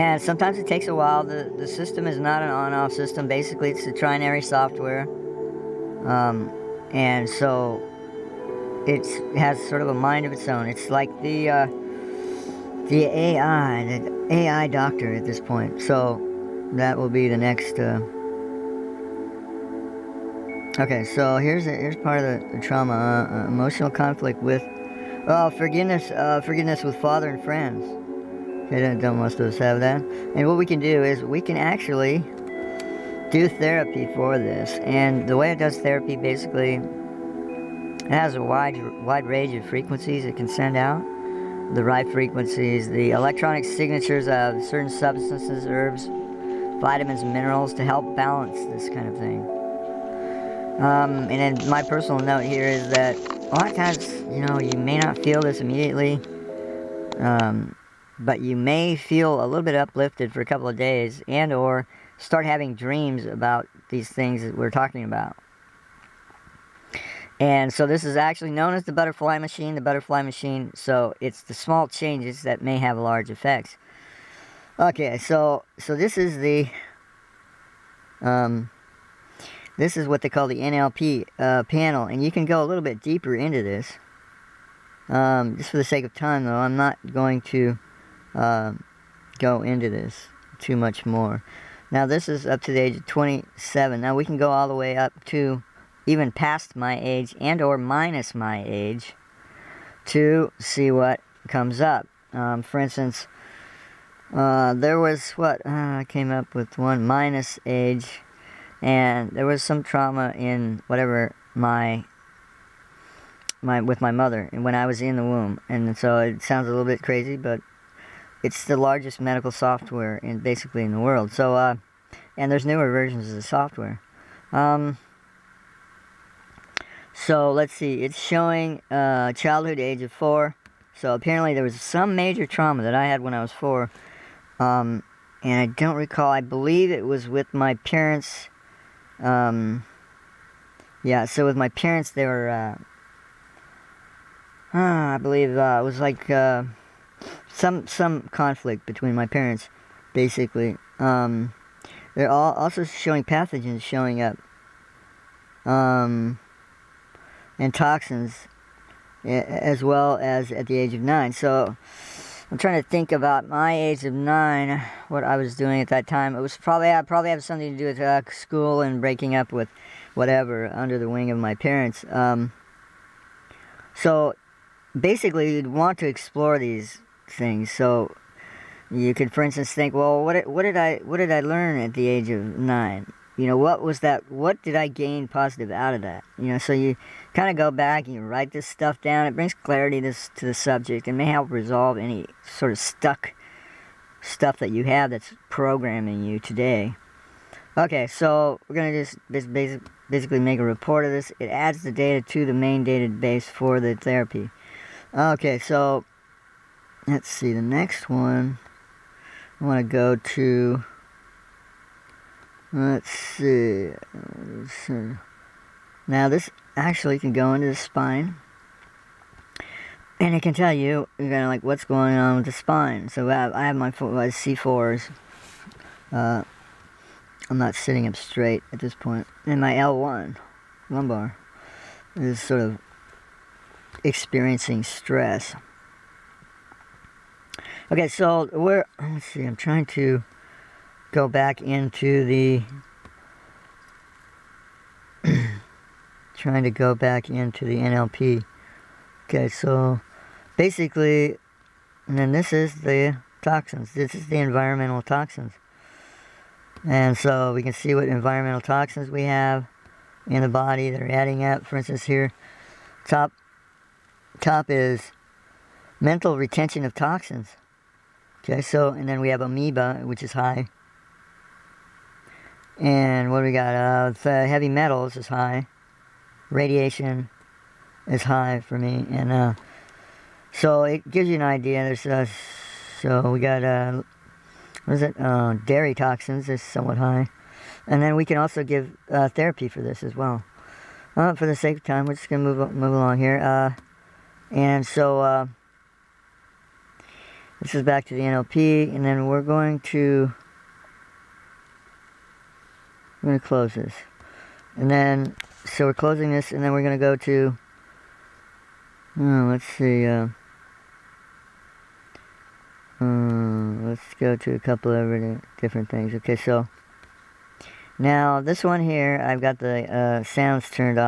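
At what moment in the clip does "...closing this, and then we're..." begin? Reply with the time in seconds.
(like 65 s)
305 s.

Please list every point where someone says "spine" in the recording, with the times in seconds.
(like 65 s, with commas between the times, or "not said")
217 s, 222 s.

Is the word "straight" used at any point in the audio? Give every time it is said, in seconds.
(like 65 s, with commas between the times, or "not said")
228 s.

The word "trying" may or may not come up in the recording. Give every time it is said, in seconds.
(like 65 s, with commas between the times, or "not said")
162 s, 239 s, 246 s.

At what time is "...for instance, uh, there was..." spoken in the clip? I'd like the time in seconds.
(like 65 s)
102 s.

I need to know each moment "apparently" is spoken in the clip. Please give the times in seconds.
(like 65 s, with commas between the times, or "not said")
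131 s.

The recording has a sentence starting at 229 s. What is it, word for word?
And my L1, lumbar, is sort of experiencing stress.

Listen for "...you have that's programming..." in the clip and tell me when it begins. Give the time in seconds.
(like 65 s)
194 s.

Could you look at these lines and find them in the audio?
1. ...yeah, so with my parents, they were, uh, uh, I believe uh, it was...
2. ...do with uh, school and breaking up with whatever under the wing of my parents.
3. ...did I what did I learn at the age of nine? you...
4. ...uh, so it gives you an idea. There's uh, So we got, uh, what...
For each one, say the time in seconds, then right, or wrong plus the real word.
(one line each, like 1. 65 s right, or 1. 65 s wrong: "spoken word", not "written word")
1. 141 s right
2. 167 s right
3. 180 s right
4. 279 s right.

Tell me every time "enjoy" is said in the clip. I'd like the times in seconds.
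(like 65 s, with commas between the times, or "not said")
not said.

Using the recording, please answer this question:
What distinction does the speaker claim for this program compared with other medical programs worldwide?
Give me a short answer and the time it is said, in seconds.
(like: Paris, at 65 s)
largest medical software, at 118 s.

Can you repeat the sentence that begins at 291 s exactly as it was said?
Uh, for the sake of time, we're just going to move, move along here.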